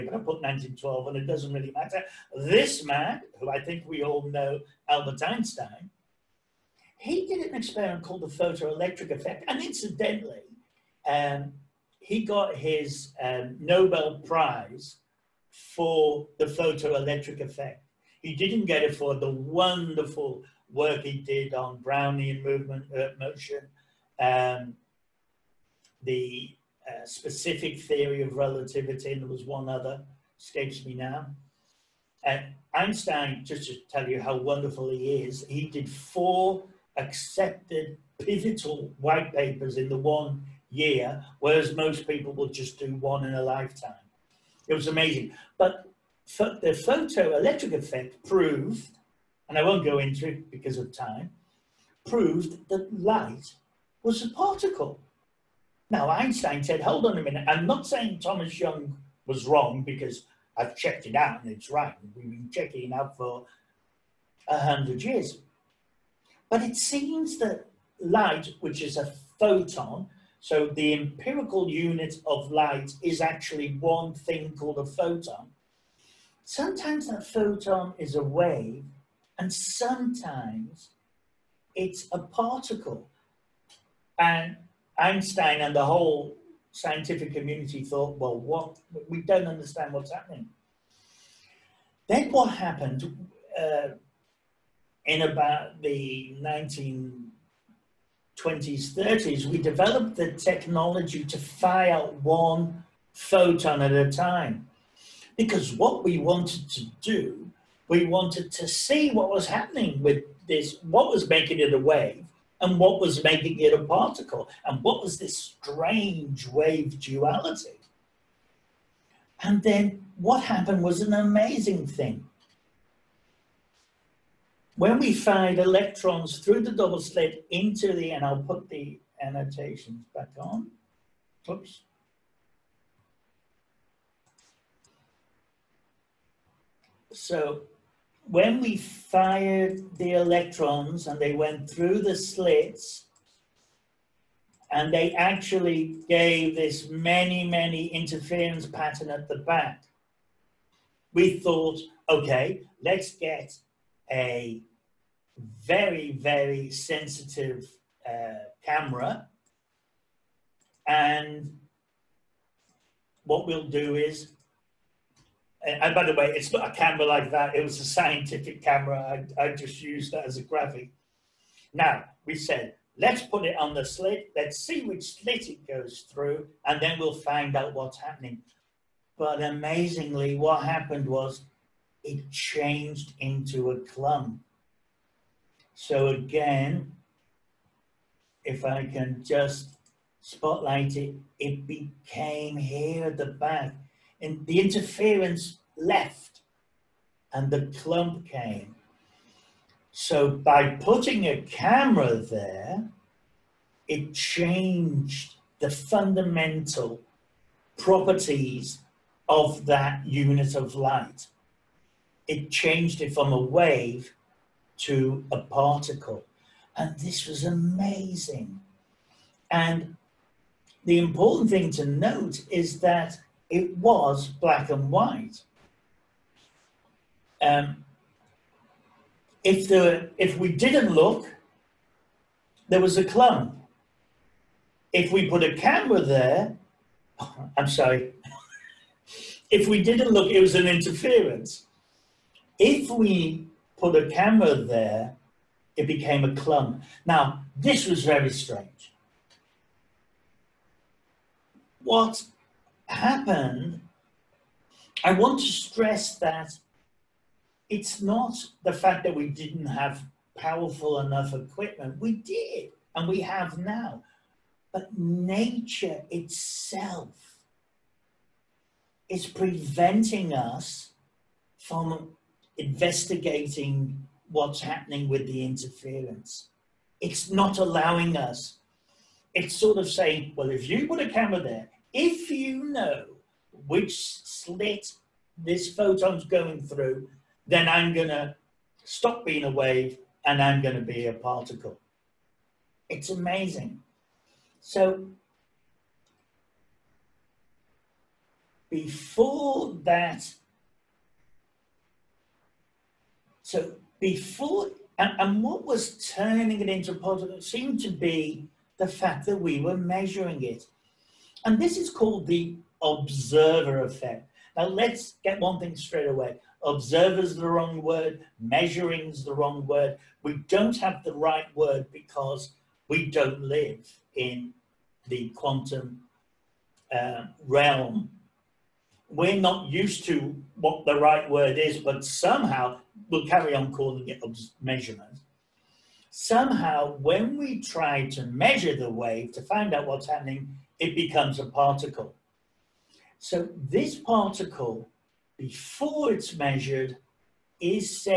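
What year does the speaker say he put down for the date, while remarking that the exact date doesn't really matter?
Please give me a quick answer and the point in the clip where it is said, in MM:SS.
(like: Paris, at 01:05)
1912, at 00:00.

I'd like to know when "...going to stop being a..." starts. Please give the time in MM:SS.
04:47.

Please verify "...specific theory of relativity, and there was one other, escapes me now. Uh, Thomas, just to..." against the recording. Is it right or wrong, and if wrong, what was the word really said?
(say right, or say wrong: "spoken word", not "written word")
wrong: "Einstein", not "Thomas".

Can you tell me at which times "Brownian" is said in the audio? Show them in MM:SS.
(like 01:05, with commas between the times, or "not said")
00:21.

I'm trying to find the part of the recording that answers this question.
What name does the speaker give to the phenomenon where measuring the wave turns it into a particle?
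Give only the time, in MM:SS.
05:12.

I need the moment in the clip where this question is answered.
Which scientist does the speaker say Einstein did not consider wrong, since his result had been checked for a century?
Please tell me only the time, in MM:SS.
00:58.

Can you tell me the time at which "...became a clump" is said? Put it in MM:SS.
04:05.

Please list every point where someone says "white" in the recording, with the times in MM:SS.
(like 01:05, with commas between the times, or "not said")
00:38, 03:44.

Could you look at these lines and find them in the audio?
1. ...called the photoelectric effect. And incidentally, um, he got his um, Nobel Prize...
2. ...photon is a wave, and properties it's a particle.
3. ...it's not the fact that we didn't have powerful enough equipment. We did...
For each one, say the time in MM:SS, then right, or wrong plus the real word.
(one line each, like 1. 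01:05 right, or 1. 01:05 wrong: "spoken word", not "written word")
1. 00:08 right
2. 01:17 wrong: "sometimes", not "properties"
3. 04:17 right.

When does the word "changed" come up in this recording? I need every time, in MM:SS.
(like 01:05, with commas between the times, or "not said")
03:02, 03:24, 03:32.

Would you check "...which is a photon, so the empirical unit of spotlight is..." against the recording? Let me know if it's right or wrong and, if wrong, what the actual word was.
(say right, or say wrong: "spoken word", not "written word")
wrong: "light", not "spotlight".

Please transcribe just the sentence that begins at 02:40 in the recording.
And what we'll do is and, and, by the way, it's not a camera like that.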